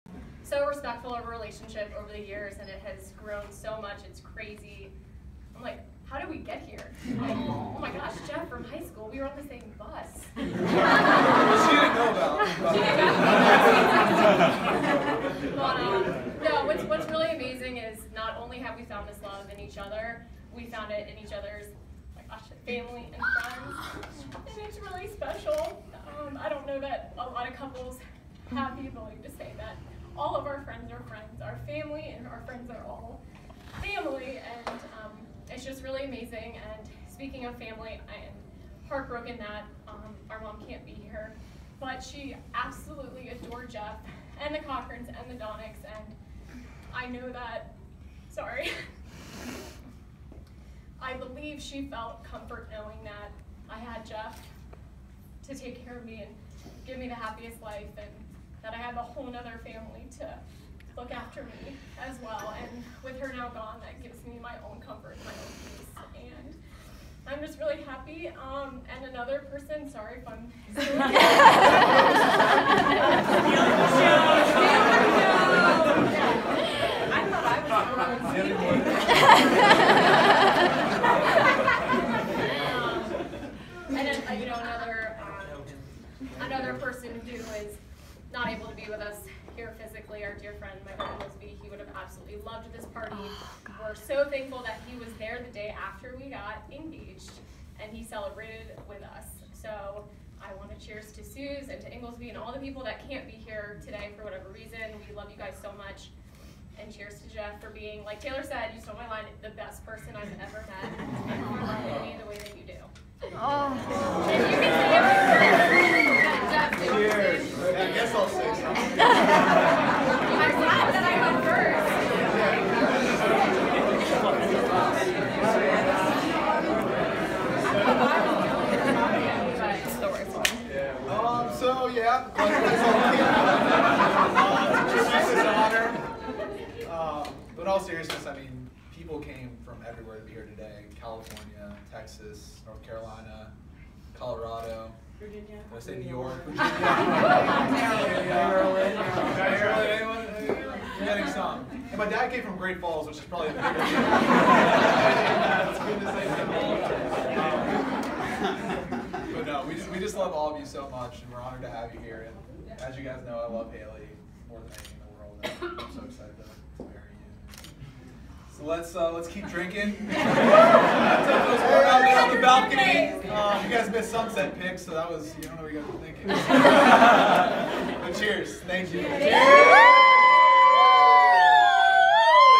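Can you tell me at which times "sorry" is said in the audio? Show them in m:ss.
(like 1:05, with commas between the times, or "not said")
0:48, 1:09.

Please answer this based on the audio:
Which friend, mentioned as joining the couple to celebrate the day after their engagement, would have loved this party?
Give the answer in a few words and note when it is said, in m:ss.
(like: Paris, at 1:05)
Lisby, at 1:31.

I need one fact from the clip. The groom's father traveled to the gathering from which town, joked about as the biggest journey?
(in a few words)
Great Falls.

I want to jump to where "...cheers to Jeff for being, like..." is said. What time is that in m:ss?
1:46.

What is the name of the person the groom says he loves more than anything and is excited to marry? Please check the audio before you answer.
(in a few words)
Haley.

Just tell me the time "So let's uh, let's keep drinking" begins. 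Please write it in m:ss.
2:48.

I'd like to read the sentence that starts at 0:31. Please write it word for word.
Our family and our friends are all family, and um, it's just really amazing.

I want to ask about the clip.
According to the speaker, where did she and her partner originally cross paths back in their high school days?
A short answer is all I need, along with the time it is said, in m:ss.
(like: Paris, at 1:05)
the same bus, at 0:09.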